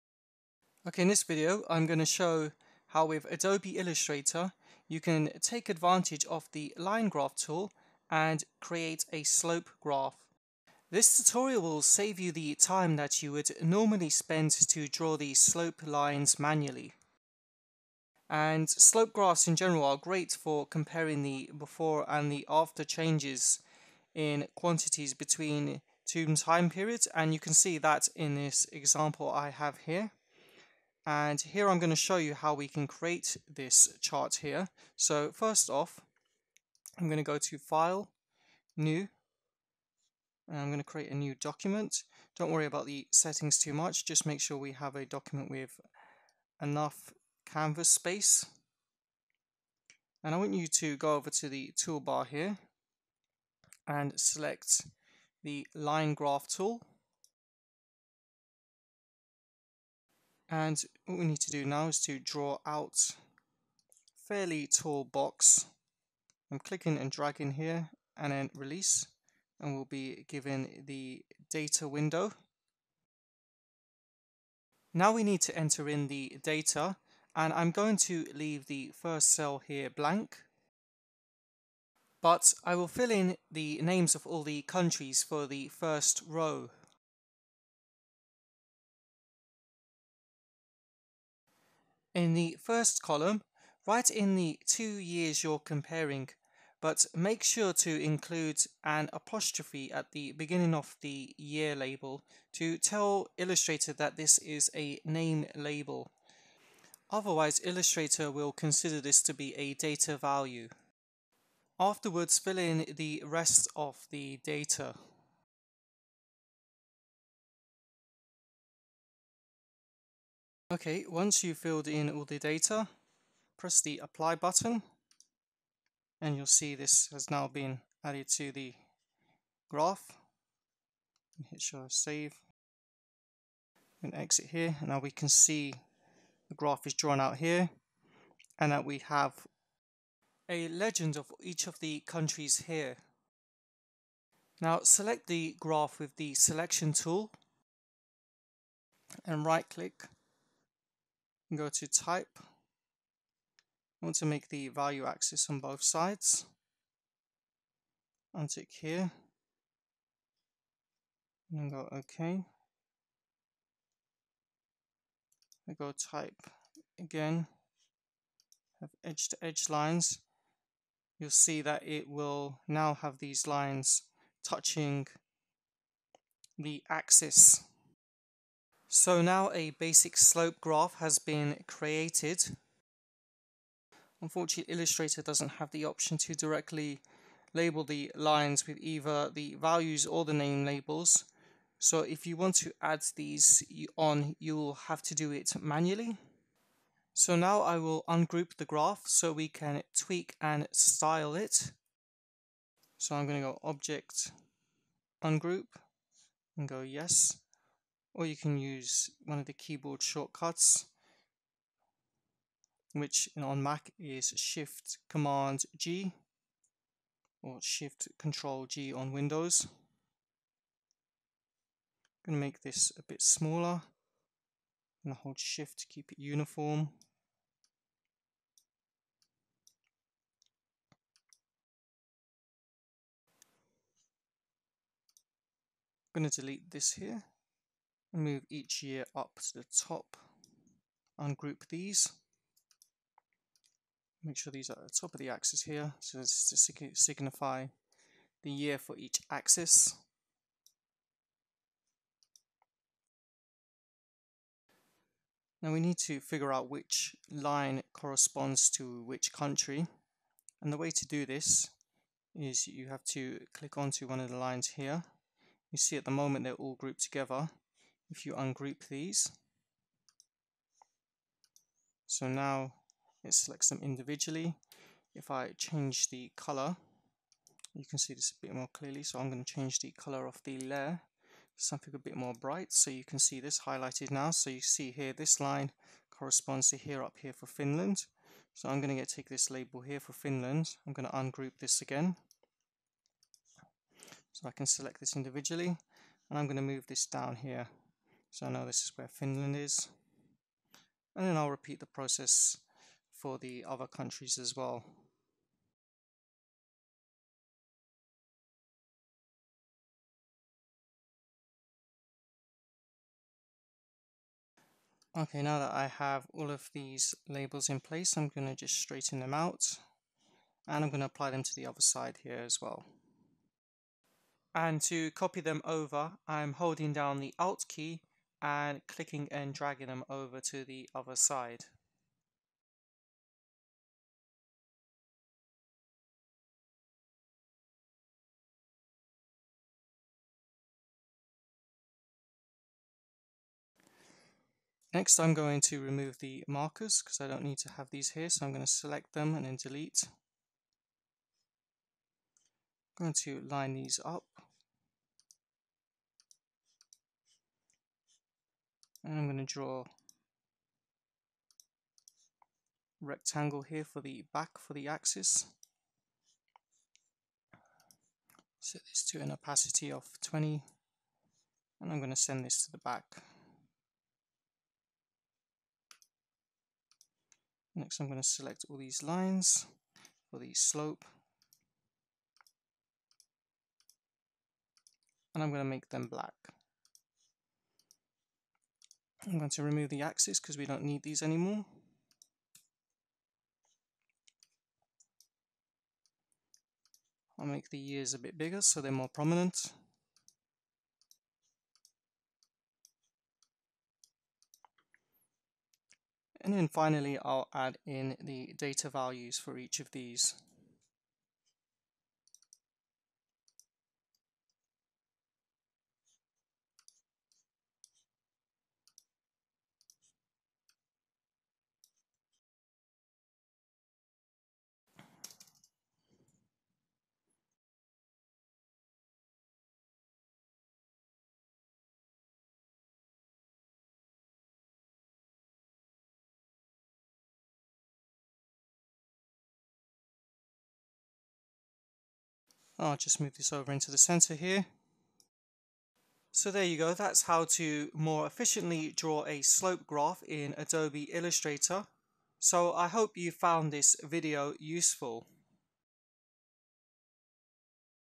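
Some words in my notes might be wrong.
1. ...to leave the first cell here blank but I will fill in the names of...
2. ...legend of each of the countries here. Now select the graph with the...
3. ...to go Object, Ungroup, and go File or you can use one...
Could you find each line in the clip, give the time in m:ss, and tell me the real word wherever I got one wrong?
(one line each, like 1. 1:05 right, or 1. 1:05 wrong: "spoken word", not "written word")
1. 1:17 right
2. 2:20 right
3. 3:23 wrong: "Yes", not "File".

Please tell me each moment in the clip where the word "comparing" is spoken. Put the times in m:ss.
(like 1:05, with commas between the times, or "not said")
0:20, 1:35.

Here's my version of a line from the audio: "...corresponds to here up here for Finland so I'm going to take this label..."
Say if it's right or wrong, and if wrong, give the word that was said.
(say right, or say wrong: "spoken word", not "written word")
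right.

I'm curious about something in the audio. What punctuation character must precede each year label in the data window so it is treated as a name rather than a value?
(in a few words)
apostrophe.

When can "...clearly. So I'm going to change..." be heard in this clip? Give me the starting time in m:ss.
4:38.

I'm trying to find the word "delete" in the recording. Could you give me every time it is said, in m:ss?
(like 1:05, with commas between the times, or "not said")
3:56, 5:49.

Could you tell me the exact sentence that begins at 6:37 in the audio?
I'll make the ears a bit bigger so they're more prominent.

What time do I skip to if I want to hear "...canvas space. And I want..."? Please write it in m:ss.
0:47.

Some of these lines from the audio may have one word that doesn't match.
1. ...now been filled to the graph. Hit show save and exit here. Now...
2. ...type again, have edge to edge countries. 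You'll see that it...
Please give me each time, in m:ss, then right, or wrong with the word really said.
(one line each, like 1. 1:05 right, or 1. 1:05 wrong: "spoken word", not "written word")
1. 2:07 wrong: "added", not "filled"
2. 2:45 wrong: "lines", not "countries".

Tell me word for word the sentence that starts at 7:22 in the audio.
I'll just move this over into the center here.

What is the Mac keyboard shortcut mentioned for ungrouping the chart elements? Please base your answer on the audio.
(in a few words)
Shift Command G.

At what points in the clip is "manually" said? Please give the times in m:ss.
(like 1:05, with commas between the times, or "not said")
0:16, 3:15.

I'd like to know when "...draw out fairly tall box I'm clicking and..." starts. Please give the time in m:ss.
1:02.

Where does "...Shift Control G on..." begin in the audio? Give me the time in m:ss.
3:37.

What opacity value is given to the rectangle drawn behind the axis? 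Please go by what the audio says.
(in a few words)
20.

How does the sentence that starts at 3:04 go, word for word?
Unfortunately Illustrator doesn't have the option to directly label the lines with either the values or the name labels.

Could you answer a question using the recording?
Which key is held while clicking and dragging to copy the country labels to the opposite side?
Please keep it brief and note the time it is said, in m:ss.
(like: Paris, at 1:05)
Alt, at 5:27.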